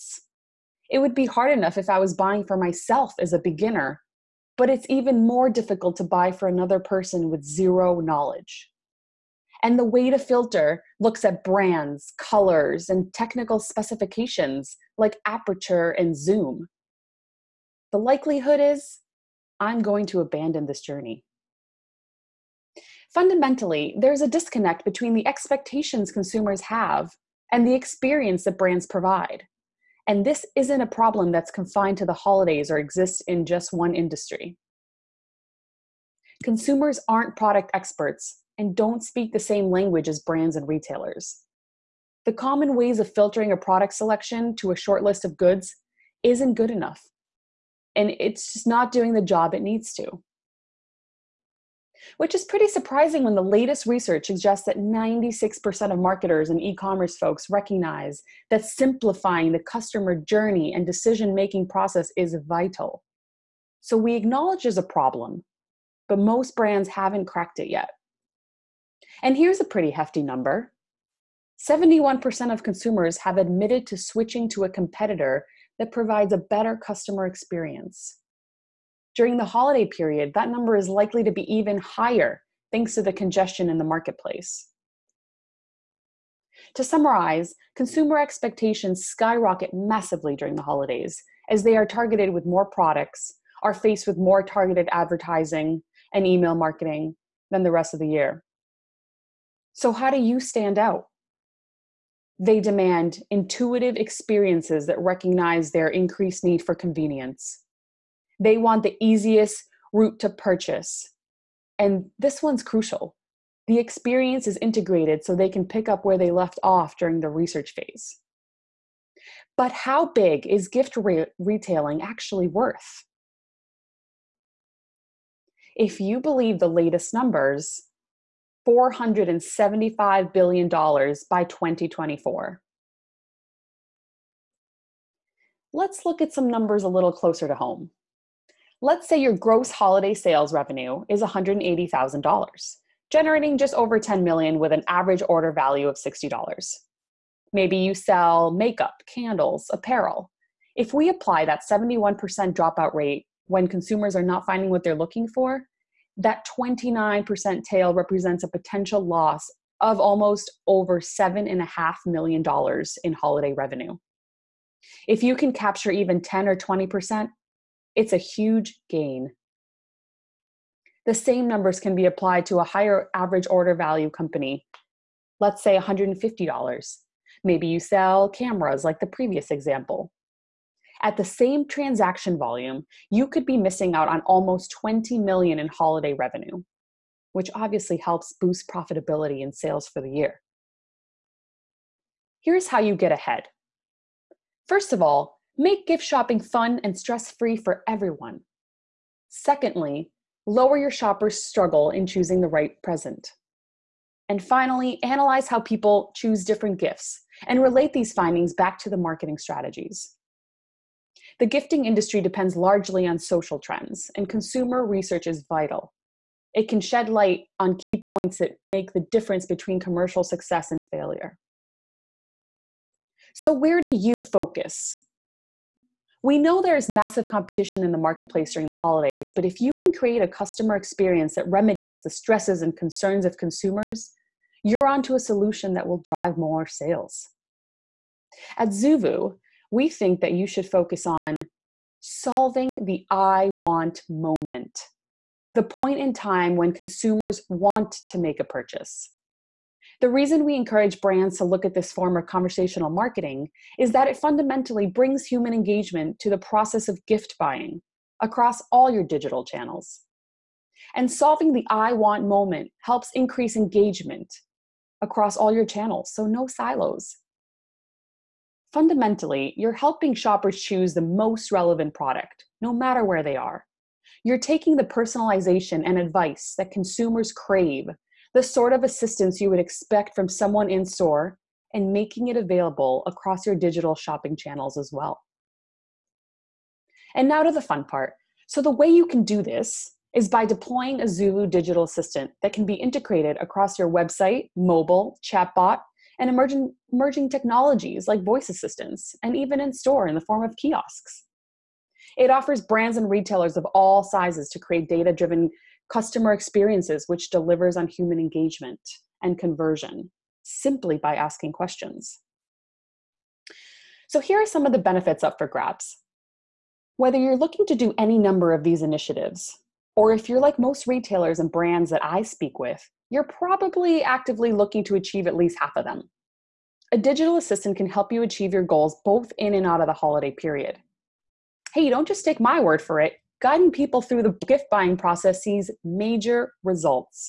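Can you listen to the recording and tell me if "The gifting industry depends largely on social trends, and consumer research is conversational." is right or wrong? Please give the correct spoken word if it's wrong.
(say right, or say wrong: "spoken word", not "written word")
wrong: "vital", not "conversational".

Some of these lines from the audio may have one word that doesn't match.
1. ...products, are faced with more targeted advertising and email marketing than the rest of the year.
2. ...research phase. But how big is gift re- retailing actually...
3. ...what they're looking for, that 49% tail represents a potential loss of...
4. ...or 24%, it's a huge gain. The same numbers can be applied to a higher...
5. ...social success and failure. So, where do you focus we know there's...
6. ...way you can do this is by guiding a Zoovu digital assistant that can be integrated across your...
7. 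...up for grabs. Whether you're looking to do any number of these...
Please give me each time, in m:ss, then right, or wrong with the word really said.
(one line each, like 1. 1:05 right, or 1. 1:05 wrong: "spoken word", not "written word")
1. 1:32 right
2. 1:57 right
3. 2:34 wrong: "29", not "49"
4. 2:46 wrong: "20", not "24"
5. 3:39 wrong: "commercial", not "social"
6. 4:48 wrong: "deploying", not "guiding"
7. 5:15 right.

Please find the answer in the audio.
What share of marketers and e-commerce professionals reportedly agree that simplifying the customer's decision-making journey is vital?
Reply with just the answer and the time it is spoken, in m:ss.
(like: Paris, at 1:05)
96%, at 0:54.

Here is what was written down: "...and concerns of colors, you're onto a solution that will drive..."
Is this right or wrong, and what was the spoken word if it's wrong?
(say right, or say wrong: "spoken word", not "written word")
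wrong: "consumers", not "colors".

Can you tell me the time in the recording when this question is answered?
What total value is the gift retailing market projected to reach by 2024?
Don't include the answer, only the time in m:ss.
2:08.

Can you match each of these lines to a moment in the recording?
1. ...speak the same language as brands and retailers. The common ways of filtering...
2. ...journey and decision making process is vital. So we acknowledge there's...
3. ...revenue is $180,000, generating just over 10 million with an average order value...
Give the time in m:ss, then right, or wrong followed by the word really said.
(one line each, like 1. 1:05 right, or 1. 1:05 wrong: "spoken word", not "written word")
1. 0:39 right
2. 1:00 right
3. 2:20 right.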